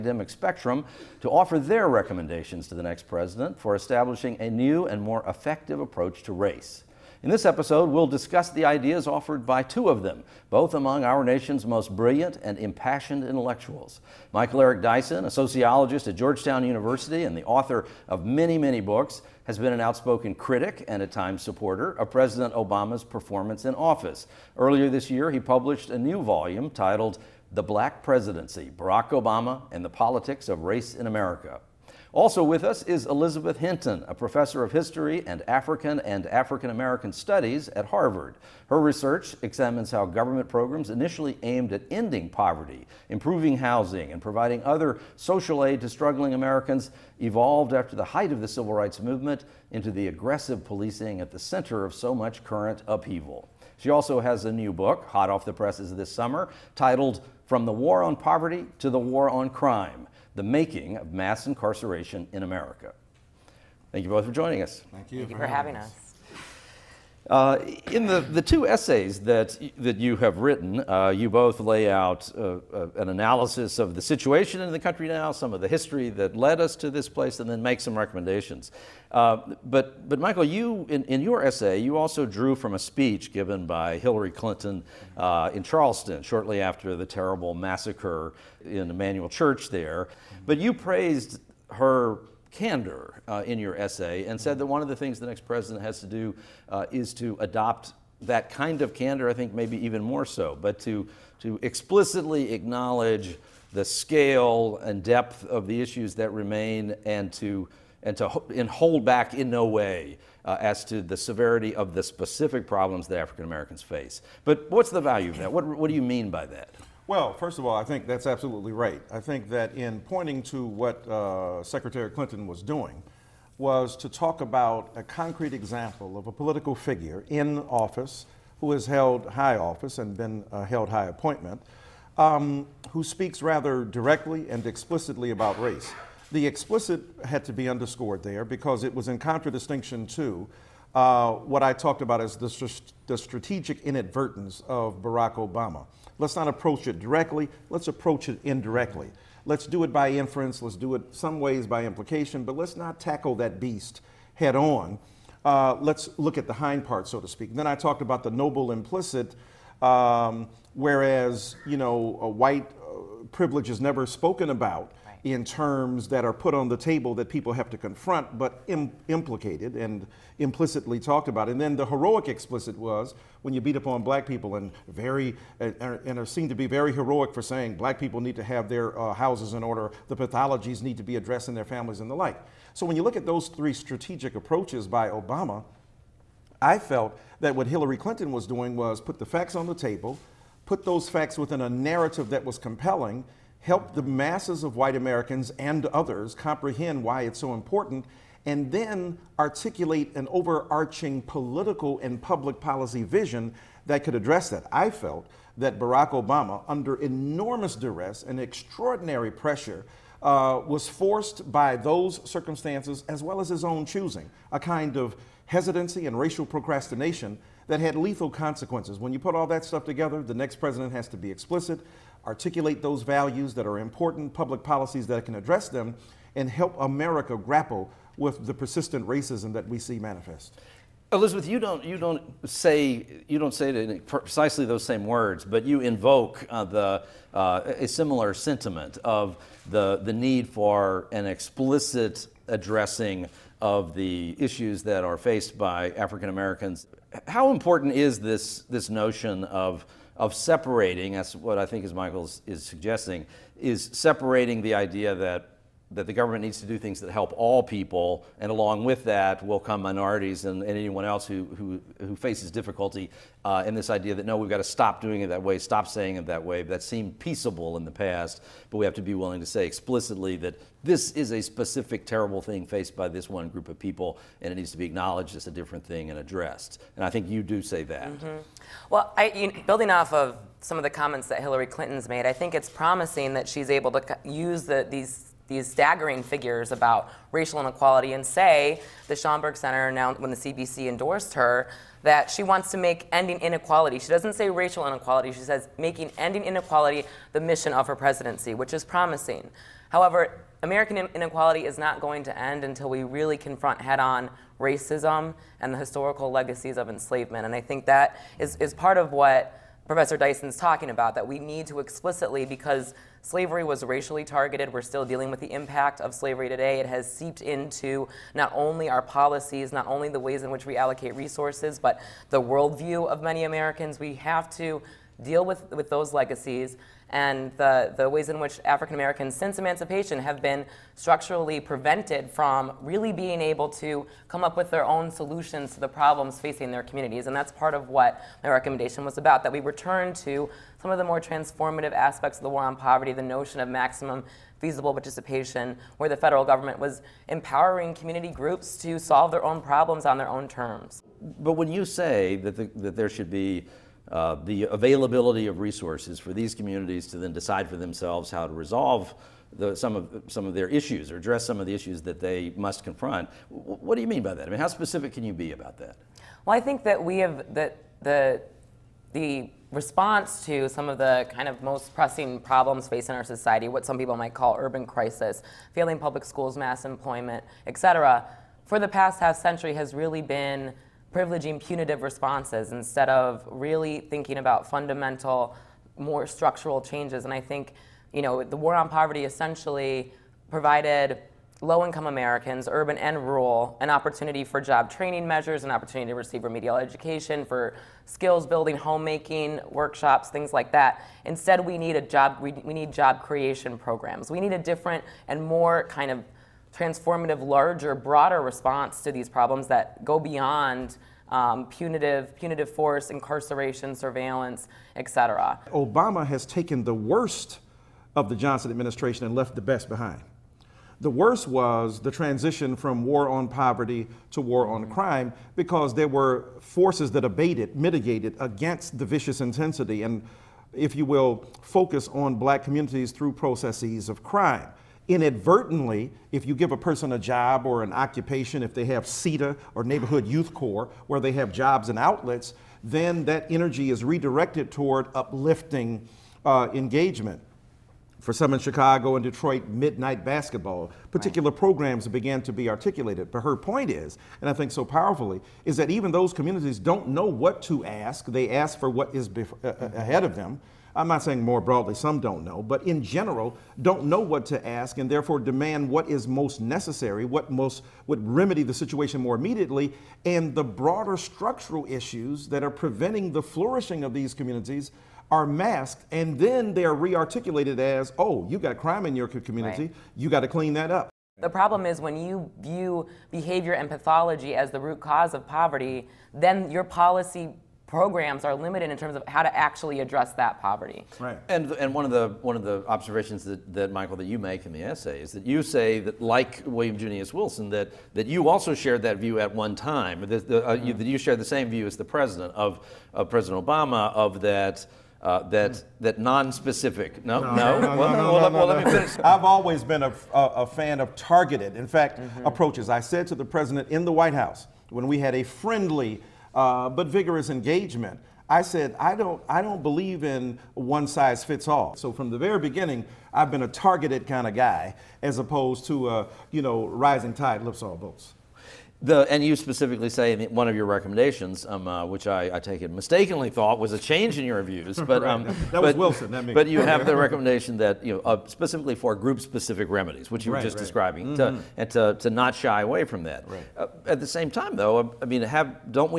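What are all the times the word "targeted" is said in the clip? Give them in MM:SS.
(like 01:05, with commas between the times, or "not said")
05:14, 08:31, 08:43.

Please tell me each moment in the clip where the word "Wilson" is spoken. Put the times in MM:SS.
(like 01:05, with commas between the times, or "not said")
08:17, 08:55.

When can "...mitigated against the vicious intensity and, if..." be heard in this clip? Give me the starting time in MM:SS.
07:07.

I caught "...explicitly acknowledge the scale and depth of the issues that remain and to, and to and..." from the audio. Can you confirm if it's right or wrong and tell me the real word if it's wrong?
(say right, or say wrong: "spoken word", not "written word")
right.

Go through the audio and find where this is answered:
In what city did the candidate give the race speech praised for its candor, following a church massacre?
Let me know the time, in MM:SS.
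01:25.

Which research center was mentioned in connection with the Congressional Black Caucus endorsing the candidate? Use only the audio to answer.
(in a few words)
Schomburg Center.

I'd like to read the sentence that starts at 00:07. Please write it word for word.
In this episode, we'll discuss the ideas offered by two of them, both among our nation's most brilliant and impassioned intellectuals.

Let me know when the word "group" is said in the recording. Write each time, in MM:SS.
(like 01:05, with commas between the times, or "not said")
04:33, 05:48, 08:59.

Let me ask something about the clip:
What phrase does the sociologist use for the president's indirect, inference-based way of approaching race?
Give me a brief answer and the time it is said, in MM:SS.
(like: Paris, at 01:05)
strategic inadvertence, at 02:23.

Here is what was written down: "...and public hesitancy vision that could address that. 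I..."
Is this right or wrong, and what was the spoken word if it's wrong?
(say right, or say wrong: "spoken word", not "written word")
wrong: "policy", not "hesitancy".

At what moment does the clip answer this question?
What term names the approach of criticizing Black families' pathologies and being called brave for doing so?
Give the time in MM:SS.
02:51.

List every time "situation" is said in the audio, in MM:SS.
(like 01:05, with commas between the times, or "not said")
01:14, 07:48.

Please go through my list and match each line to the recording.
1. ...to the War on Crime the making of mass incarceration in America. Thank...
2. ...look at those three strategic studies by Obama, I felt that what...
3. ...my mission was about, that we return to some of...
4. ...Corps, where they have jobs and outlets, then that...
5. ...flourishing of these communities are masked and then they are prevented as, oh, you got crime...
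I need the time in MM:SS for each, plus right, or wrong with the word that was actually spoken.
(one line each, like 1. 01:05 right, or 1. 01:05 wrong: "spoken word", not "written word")
1. 00:58 right
2. 03:03 wrong: "approaches", not "studies"
3. 05:38 wrong: "recommendation", not "mission"
4. 07:20 right
5. 07:53 wrong: "rearticulated", not "prevented".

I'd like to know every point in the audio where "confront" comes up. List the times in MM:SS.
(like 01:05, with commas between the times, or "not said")
02:47, 05:03, 06:02.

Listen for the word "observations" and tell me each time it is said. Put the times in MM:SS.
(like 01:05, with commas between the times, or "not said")
08:12.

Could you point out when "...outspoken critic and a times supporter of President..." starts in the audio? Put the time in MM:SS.
00:19.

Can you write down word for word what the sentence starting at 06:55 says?
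Obama has taken the worst of the Johnson administration and left the best behind.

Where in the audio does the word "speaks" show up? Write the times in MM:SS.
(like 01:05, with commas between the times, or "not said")
02:13, 02:37.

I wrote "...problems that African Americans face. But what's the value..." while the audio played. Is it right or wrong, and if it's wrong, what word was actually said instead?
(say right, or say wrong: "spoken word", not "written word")
right.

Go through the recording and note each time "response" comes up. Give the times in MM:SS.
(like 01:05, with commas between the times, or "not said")
06:09, 06:22, 06:48.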